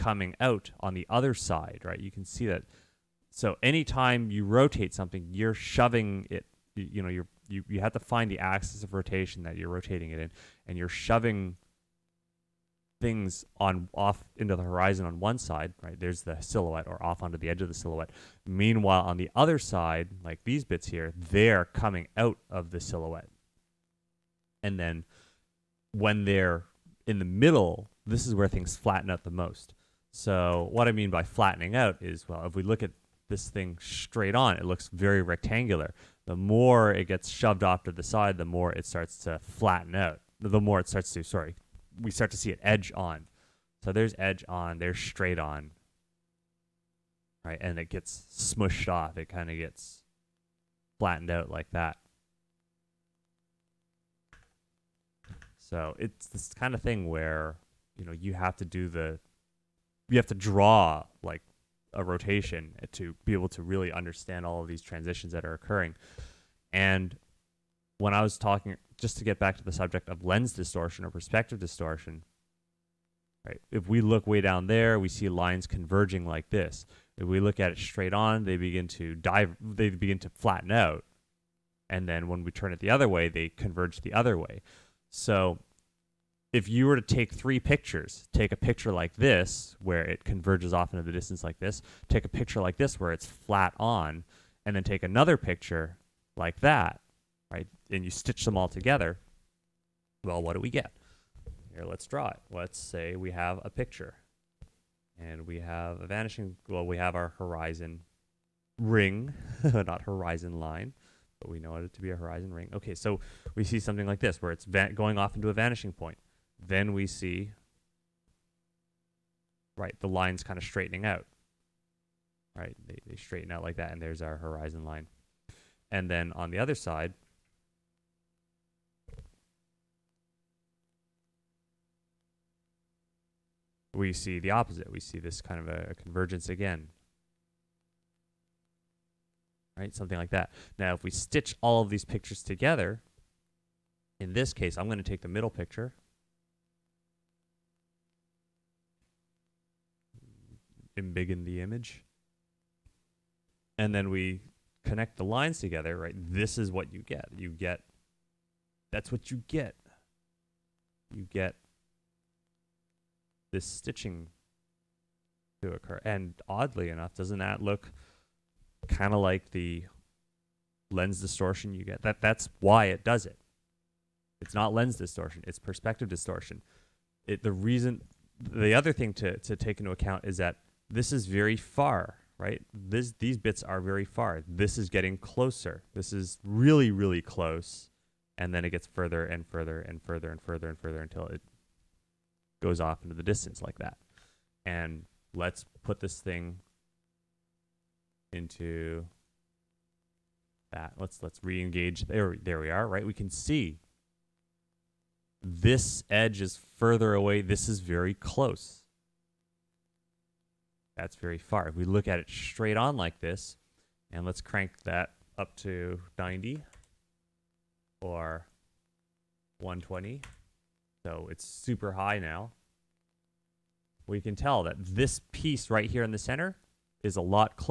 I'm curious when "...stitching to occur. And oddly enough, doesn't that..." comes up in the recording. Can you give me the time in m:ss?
2:43.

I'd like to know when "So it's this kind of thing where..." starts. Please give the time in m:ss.
0:55.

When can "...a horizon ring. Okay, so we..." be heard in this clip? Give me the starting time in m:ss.
1:52.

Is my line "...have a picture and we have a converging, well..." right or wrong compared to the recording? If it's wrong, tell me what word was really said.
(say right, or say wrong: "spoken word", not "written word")
wrong: "vanishing", not "converging".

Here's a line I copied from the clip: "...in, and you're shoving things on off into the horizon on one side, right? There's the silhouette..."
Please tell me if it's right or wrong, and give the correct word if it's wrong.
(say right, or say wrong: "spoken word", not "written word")
right.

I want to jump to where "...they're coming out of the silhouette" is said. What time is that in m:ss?
0:21.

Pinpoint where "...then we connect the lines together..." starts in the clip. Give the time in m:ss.
2:33.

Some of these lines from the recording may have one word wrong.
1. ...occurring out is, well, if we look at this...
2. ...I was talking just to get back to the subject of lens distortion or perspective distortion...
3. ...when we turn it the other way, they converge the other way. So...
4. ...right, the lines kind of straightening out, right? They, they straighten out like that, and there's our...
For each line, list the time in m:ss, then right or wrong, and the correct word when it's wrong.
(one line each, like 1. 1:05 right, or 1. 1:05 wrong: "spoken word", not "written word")
1. 0:31 wrong: "flattening", not "occurring"
2. 1:08 right
3. 1:22 right
4. 1:59 right.